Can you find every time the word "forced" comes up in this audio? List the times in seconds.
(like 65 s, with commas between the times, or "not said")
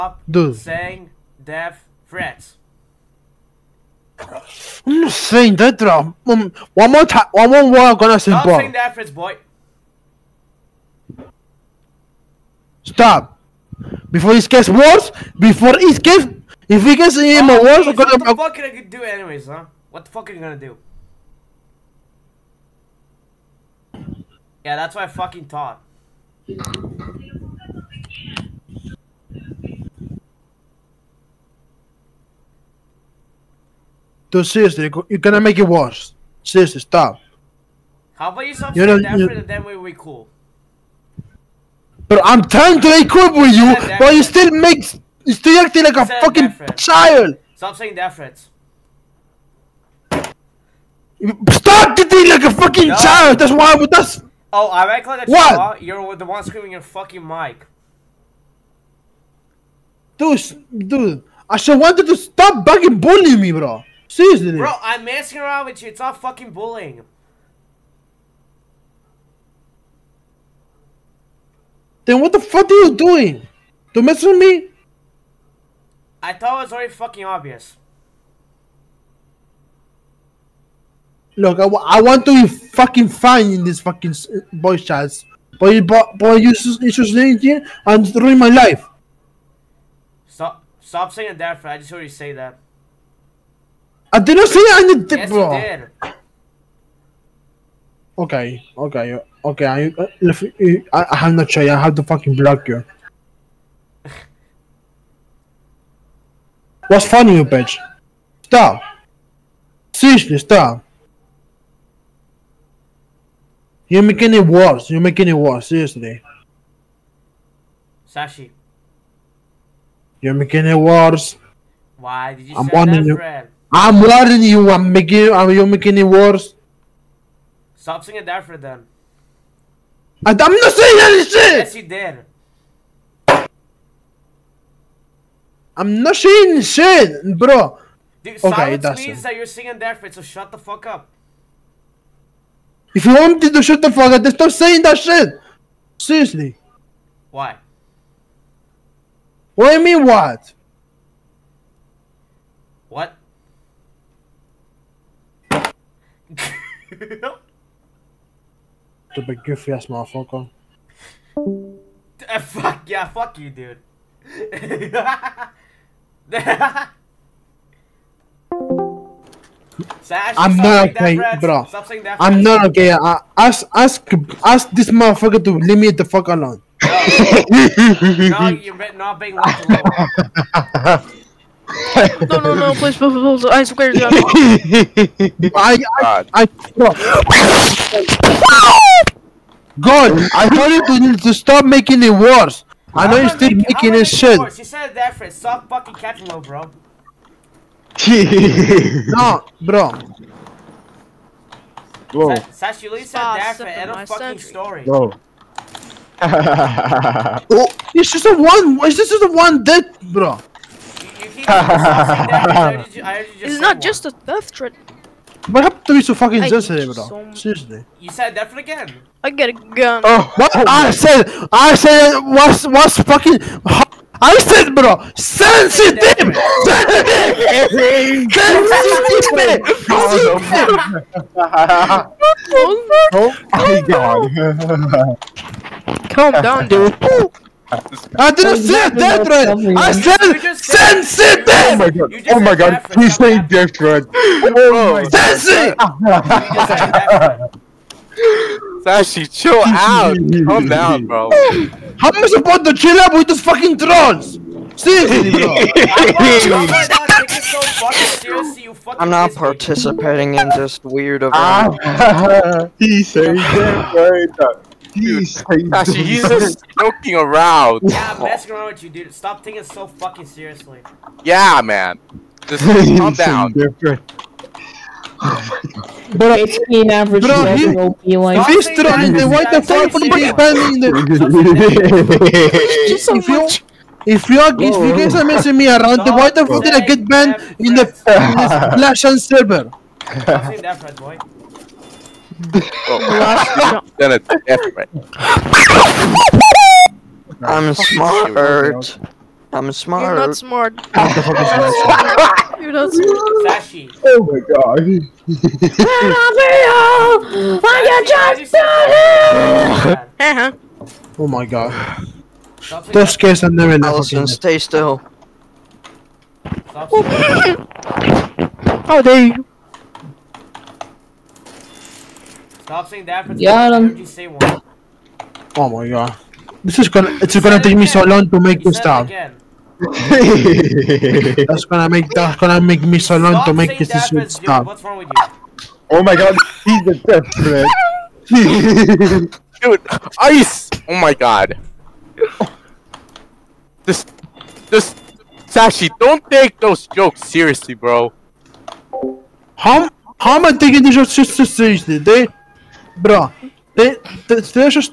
not said.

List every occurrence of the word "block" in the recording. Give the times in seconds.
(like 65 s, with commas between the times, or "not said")
102 s.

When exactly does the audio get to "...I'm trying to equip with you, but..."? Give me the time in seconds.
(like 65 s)
42 s.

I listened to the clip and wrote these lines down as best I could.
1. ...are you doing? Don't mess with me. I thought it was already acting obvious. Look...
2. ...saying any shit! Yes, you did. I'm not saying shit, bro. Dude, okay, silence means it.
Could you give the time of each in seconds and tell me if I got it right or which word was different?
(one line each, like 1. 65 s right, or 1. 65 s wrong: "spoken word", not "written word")
1. 72 s wrong: "fucking", not "acting"
2. 130 s right.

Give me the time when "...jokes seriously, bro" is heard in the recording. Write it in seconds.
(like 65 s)
346 s.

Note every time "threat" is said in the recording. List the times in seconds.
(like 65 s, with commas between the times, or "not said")
2 s, 8 s, 48 s, 214 s, 239 s, 243 s, 264 s.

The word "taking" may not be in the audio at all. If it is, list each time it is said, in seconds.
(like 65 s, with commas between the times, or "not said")
269 s, 350 s.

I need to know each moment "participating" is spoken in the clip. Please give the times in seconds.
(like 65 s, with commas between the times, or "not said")
259 s.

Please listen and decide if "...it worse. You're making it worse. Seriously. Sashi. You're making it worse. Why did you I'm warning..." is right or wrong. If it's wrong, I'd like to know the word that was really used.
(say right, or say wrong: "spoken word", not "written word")
right.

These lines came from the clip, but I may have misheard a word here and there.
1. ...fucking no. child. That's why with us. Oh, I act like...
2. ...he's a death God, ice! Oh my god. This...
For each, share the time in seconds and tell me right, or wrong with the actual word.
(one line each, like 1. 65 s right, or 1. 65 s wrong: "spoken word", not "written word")
1. 52 s right
2. 336 s wrong: "Dude", not "God".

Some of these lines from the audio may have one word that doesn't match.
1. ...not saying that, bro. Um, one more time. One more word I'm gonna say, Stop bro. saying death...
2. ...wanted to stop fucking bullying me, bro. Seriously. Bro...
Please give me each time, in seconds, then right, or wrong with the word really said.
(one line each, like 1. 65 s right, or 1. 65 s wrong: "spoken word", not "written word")
1. 5 s right
2. 61 s right.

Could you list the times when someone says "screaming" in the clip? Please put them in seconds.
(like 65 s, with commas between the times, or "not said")
56 s.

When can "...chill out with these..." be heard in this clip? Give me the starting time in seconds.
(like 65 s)
252 s.